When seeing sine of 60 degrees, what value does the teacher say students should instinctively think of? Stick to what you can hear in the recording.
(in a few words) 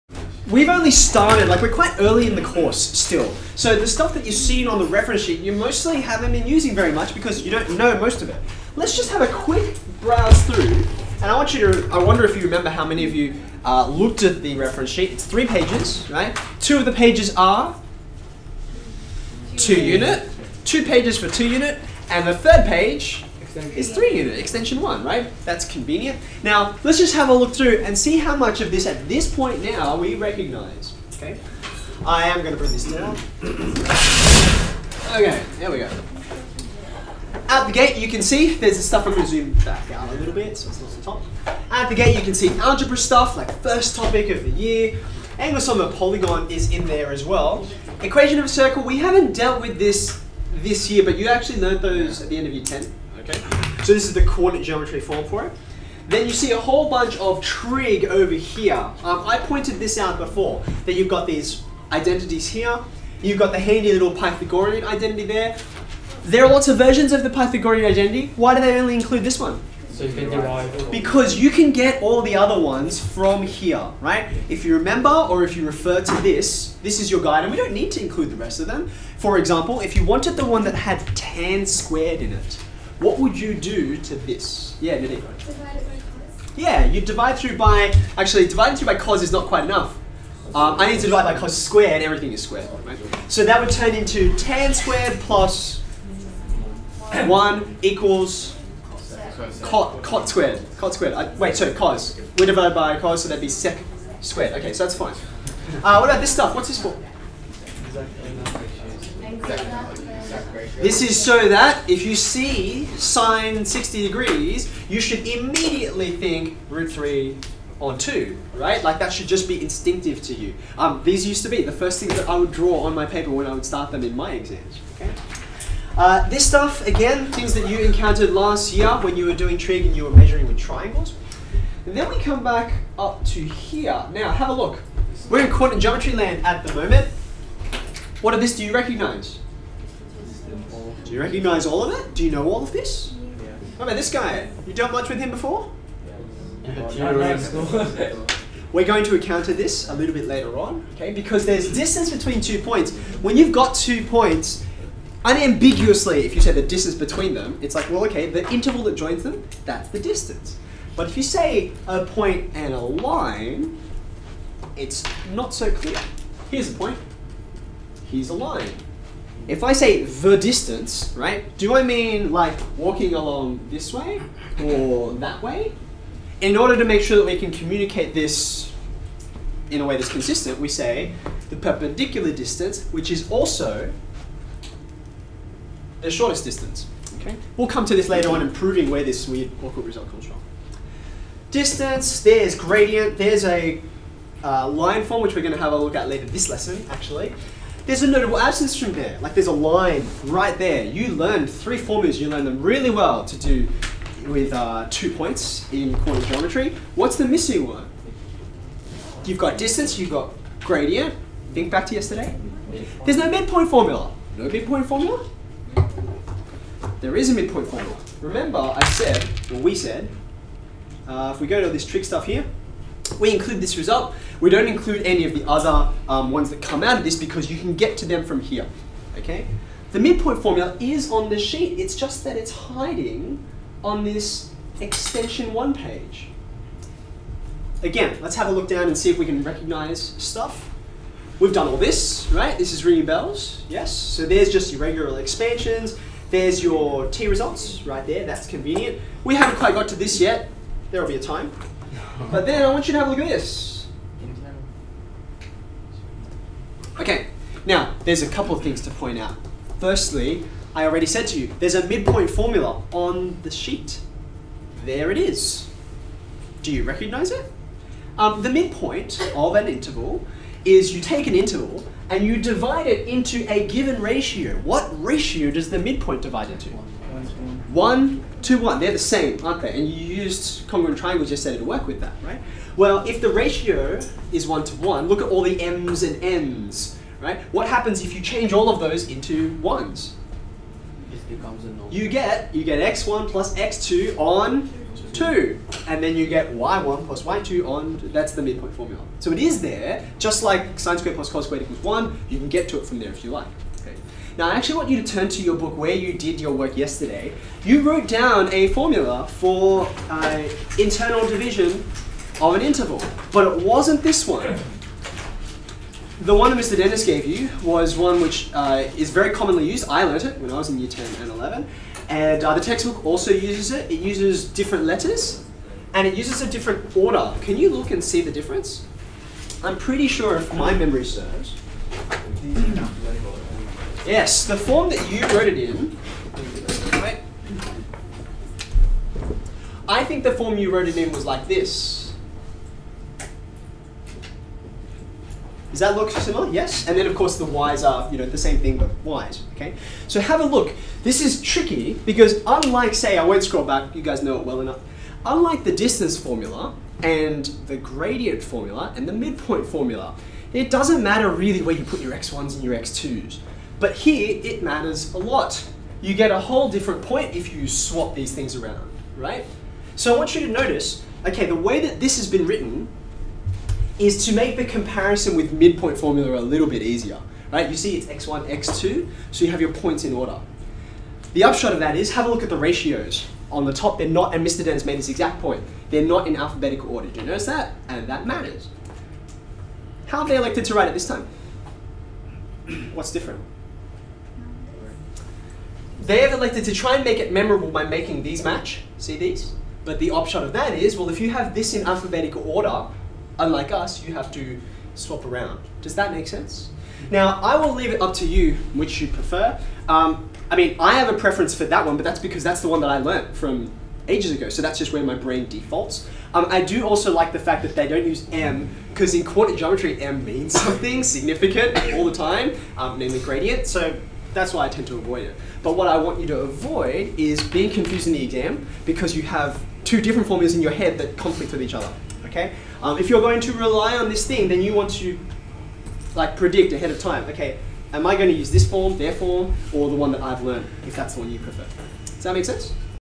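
root 3 on 2.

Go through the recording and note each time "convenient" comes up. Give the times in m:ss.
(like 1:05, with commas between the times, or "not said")
0:25, 4:08.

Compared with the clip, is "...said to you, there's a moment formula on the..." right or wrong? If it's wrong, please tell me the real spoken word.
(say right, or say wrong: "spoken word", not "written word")
wrong: "midpoint", not "moment".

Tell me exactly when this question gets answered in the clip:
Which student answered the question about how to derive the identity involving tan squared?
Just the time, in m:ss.
1:25.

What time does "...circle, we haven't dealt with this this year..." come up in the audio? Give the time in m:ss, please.
0:48.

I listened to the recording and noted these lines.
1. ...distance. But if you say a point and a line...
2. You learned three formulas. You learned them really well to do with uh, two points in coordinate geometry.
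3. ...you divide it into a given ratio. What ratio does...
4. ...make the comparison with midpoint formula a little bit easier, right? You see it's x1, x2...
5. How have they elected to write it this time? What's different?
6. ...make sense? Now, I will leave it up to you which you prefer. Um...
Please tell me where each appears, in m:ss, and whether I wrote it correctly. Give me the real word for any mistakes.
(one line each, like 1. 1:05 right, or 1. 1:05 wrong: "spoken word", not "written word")
1. 2:39 right
2. 3:20 right
3. 4:32 right
4. 6:14 right
5. 6:30 right
6. 6:46 right.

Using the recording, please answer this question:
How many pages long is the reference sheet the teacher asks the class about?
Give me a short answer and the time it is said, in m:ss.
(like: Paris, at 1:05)
3, at 0:15.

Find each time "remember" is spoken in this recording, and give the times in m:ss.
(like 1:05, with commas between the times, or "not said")
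0:12, 1:14, 3:38.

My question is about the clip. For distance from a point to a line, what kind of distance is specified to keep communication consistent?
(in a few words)
perpendicular distance.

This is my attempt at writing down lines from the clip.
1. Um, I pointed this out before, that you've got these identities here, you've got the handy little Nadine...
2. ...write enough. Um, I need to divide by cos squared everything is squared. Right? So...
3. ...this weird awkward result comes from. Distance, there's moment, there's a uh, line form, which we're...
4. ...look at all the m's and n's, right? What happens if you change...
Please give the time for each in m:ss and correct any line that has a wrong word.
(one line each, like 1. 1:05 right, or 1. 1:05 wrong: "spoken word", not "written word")
1. 0:59 wrong: "Pythagorean", not "Nadine"
2. 1:29 wrong: "quite", not "write"
3. 3:09 wrong: "gradient", not "moment"
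4. 4:45 right.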